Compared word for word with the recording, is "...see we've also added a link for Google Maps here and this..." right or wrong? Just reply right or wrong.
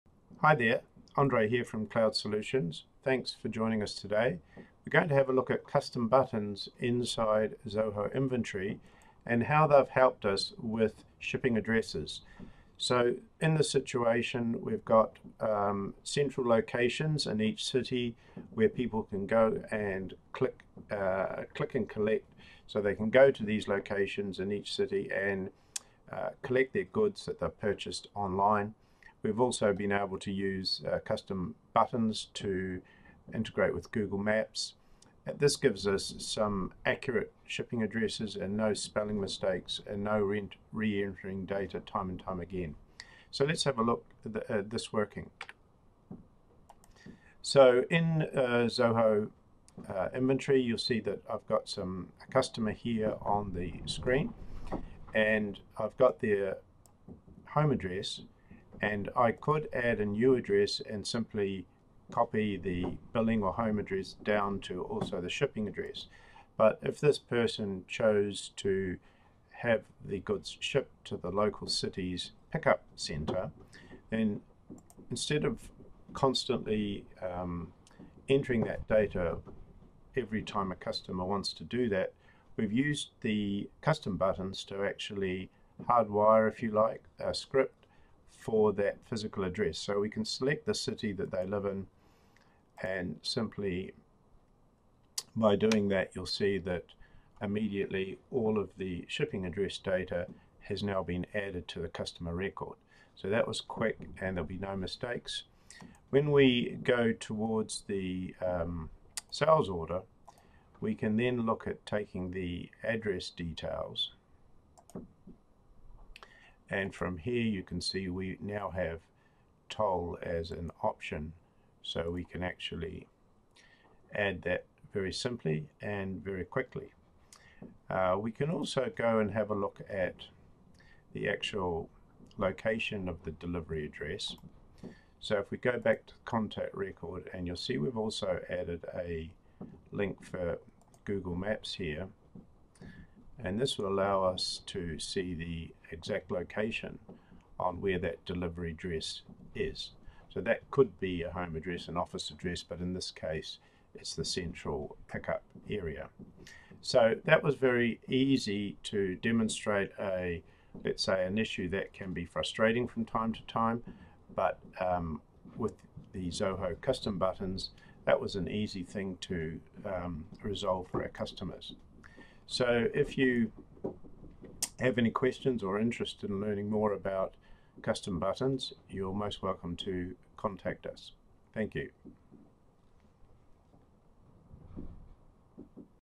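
right.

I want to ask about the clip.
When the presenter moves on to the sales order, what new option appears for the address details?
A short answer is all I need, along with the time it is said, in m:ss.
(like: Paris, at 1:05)
toll, at 1:59.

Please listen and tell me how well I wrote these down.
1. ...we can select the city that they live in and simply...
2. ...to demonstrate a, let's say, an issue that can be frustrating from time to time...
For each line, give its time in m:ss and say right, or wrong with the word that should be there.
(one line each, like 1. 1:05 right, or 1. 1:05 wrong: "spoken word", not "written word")
1. 1:29 right
2. 2:38 right.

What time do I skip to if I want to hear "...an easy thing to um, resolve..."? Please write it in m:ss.
2:48.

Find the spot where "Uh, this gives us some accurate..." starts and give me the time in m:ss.
0:35.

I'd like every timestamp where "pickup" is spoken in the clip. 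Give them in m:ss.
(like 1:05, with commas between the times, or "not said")
1:12, 2:35.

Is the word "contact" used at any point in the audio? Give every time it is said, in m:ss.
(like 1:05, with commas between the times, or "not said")
2:16, 3:00.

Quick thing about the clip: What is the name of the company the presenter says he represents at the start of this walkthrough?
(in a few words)
Cloud Solutions.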